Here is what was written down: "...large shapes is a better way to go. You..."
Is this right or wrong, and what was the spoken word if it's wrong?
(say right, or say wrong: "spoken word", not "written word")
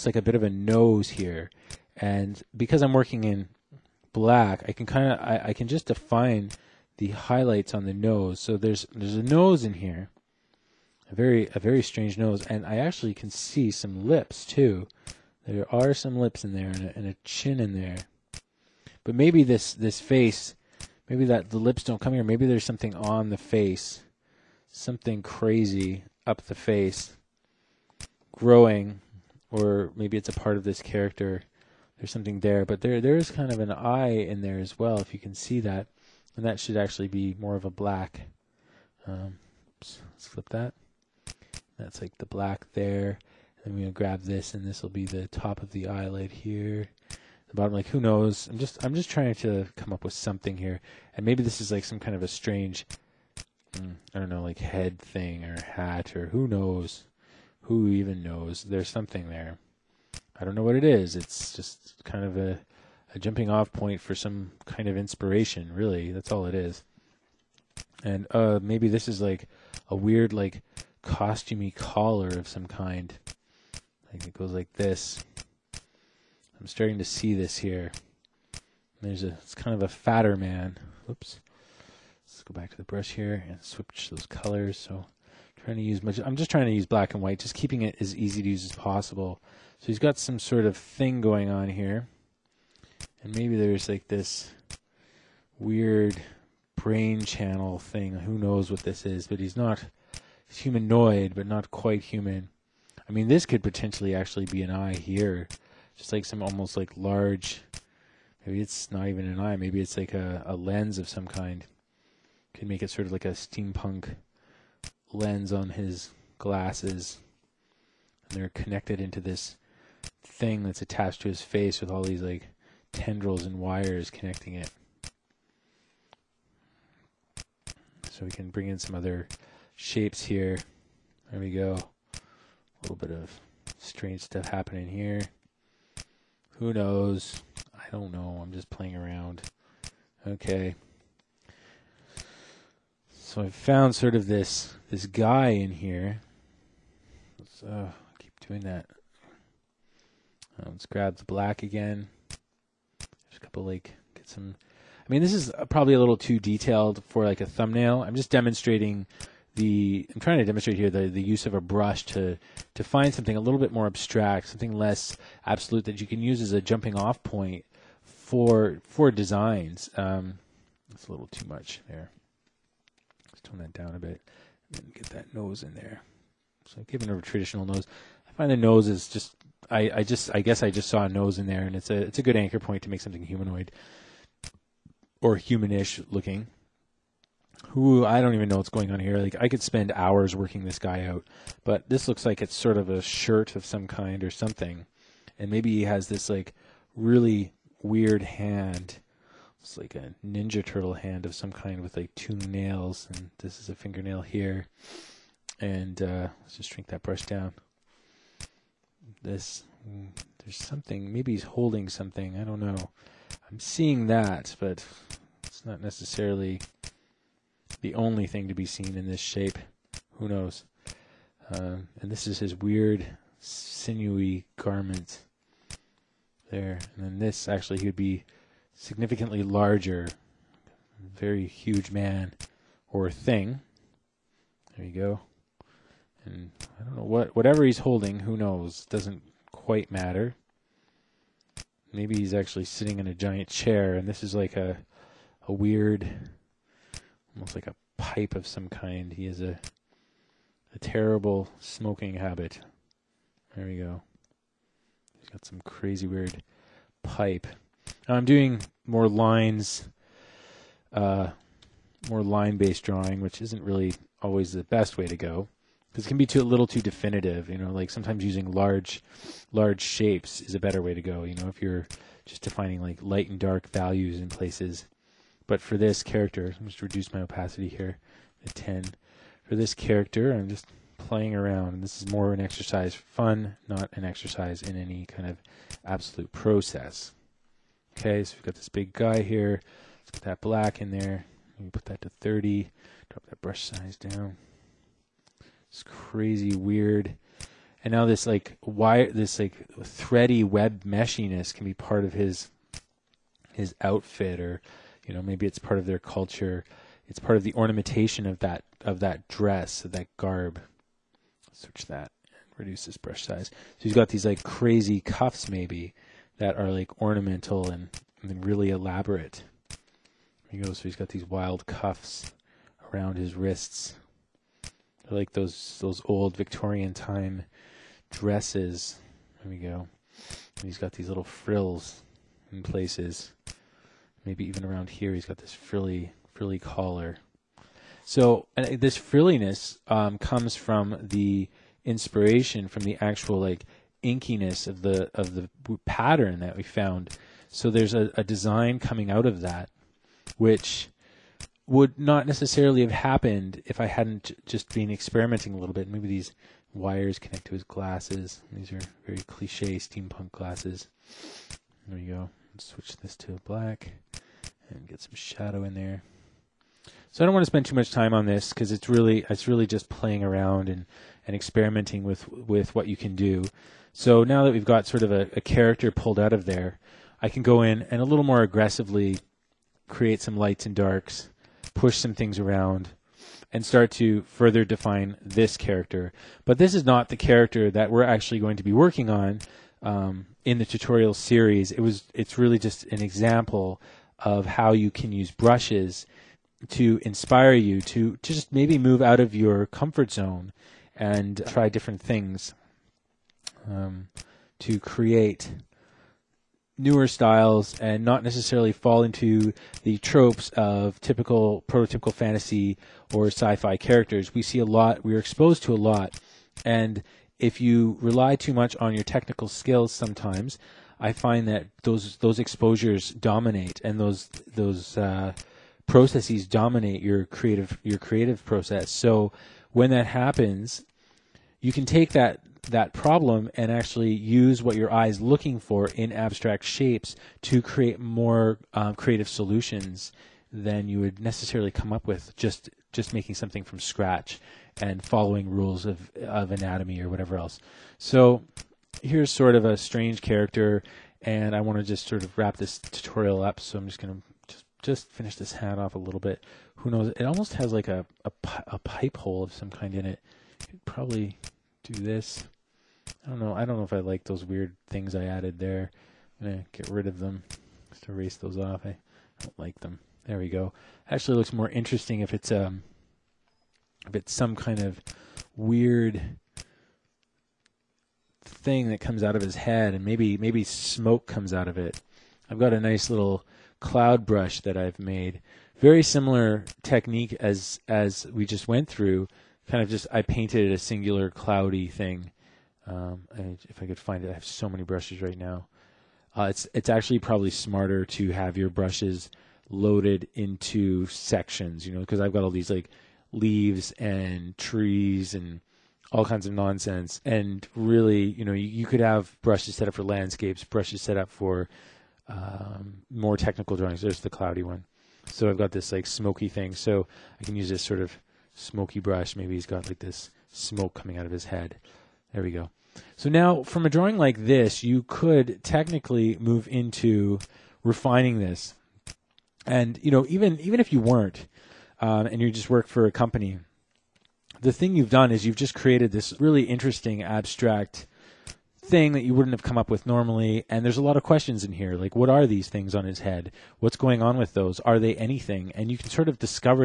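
right.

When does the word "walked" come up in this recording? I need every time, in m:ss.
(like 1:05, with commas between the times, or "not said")
not said.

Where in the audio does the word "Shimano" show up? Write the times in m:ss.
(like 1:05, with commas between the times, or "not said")
not said.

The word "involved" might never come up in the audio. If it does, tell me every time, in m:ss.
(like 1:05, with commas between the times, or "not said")
not said.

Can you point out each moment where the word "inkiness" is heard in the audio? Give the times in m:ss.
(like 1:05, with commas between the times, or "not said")
5:44.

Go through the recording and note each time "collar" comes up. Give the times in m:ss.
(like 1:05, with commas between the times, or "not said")
1:11, 5:36.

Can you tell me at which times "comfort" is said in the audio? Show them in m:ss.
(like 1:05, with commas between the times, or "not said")
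6:39.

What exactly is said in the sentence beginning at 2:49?
Um, it's a little too much there.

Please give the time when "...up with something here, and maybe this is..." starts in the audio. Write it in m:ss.
0:49.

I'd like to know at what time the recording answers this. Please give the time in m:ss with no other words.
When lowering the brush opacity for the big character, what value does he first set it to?
4:38.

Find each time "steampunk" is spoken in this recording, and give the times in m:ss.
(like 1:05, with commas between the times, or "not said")
1:53, 5:59.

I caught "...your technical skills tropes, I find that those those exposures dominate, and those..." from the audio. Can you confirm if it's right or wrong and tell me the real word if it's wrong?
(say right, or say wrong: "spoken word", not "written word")
wrong: "sometimes", not "tropes".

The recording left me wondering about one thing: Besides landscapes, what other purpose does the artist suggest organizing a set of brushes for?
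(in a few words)
technical drawings.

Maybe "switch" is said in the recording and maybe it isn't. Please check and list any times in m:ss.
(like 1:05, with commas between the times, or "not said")
1:23, 6:02.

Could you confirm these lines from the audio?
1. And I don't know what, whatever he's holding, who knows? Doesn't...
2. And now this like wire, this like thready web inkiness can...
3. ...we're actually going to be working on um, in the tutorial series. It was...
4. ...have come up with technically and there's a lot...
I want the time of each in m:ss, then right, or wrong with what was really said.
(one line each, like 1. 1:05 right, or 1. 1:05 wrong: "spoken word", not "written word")
1. 3:56 right
2. 4:57 wrong: "meshiness", not "inkiness"
3. 6:27 right
4. 8:59 wrong: "normally", not "technically".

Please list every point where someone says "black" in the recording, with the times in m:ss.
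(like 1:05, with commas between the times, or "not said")
0:04, 0:37, 0:42, 1:26, 2:31, 4:50, 6:03.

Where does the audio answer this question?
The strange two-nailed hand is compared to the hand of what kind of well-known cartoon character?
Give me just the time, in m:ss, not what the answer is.
3:20.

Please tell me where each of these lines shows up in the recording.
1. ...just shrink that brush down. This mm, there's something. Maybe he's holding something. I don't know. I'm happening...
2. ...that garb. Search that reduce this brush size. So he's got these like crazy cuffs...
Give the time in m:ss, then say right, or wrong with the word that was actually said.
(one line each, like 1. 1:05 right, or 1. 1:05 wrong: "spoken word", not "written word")
1. 3:26 wrong: "seeing", not "happening"
2. 5:09 right.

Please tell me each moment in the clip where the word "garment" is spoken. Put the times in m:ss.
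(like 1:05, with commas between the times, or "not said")
3:44.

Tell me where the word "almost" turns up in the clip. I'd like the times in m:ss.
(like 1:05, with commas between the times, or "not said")
1:46, 4:07, 7:37.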